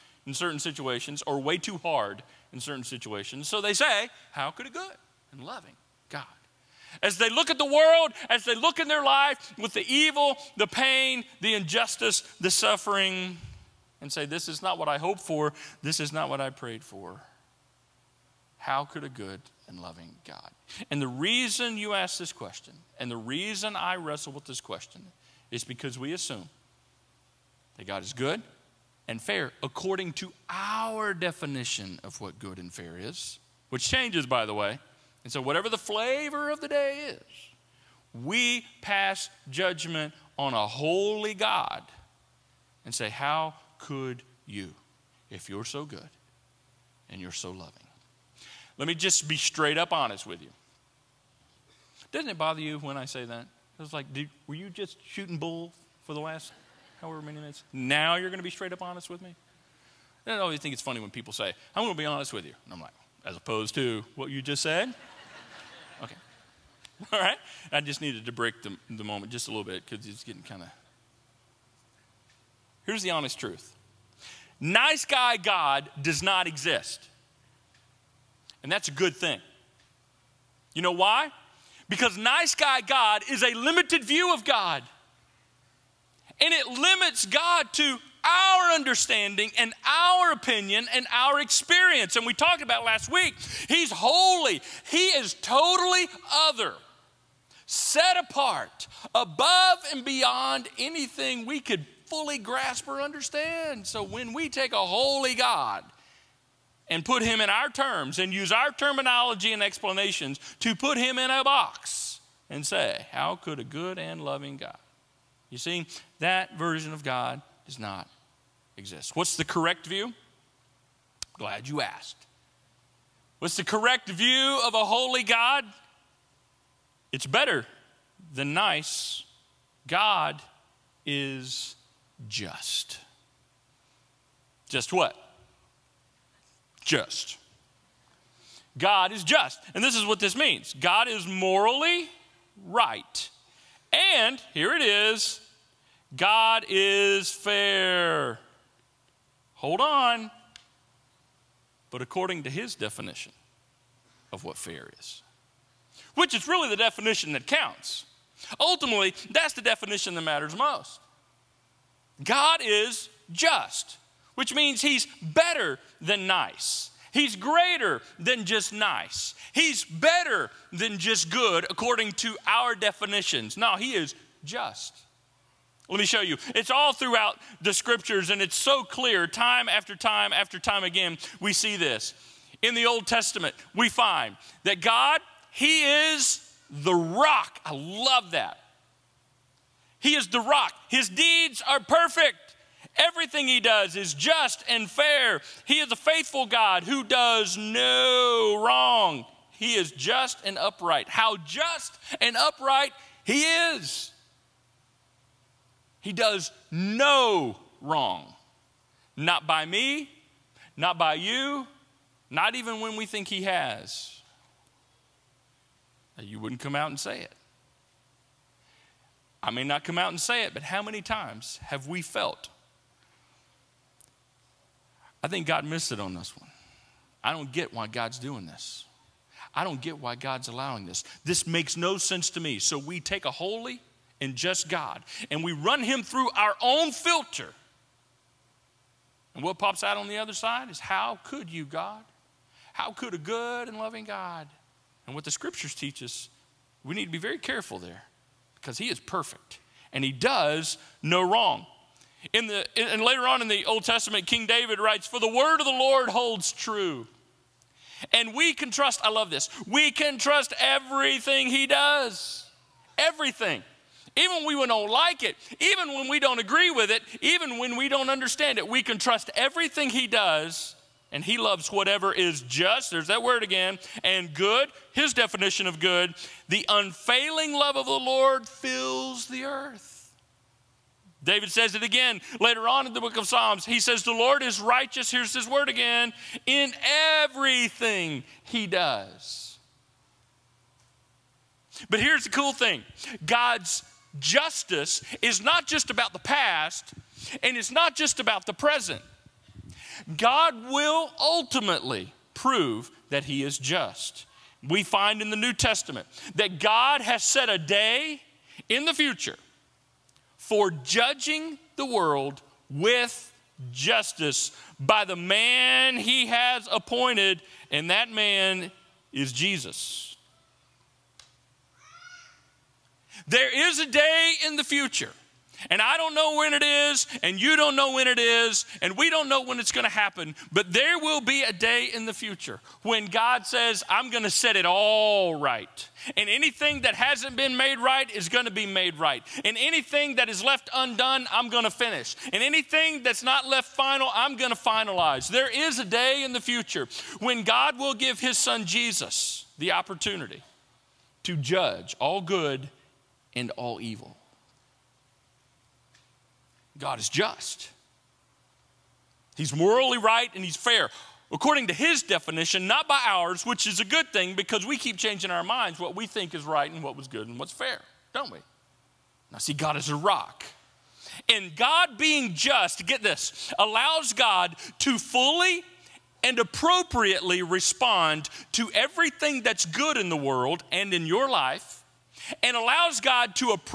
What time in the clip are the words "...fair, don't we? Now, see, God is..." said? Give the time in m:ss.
6:07.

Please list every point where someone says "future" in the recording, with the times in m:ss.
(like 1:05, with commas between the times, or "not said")
5:08, 5:24, 5:32, 5:46.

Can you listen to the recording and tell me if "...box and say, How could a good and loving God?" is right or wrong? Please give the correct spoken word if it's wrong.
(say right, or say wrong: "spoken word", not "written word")
right.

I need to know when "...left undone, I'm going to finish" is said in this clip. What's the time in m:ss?
5:40.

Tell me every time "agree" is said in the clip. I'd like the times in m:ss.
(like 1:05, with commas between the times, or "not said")
4:26.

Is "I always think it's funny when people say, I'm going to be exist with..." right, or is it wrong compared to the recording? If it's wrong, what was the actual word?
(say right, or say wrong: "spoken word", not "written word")
wrong: "honest", not "exist".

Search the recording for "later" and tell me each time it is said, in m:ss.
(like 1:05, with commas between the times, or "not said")
4:13, 4:42.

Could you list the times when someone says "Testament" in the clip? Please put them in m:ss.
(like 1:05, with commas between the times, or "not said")
3:03, 4:13, 5:05.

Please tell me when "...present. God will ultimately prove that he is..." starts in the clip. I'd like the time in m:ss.
4:58.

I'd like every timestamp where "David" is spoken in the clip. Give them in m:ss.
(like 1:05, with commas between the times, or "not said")
4:14, 4:41.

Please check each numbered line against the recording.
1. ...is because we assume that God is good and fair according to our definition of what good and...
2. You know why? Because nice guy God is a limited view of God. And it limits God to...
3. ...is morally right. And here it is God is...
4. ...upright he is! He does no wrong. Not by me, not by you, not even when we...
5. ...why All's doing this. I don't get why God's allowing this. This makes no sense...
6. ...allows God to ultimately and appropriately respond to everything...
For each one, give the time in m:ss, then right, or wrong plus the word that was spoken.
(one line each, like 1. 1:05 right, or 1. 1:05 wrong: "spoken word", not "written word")
1. 0:25 right
2. 1:20 right
3. 2:21 right
4. 3:22 right
5. 3:47 wrong: "God", not "All"
6. 6:13 wrong: "fully", not "ultimately".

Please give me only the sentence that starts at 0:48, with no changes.
Let me just be straight up honest with you.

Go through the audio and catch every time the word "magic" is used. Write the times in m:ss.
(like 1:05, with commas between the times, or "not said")
not said.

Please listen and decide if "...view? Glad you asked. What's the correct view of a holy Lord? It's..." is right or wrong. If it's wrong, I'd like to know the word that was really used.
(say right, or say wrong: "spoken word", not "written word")
wrong: "God", not "Lord".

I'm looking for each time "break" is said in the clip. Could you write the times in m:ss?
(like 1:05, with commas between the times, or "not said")
1:08.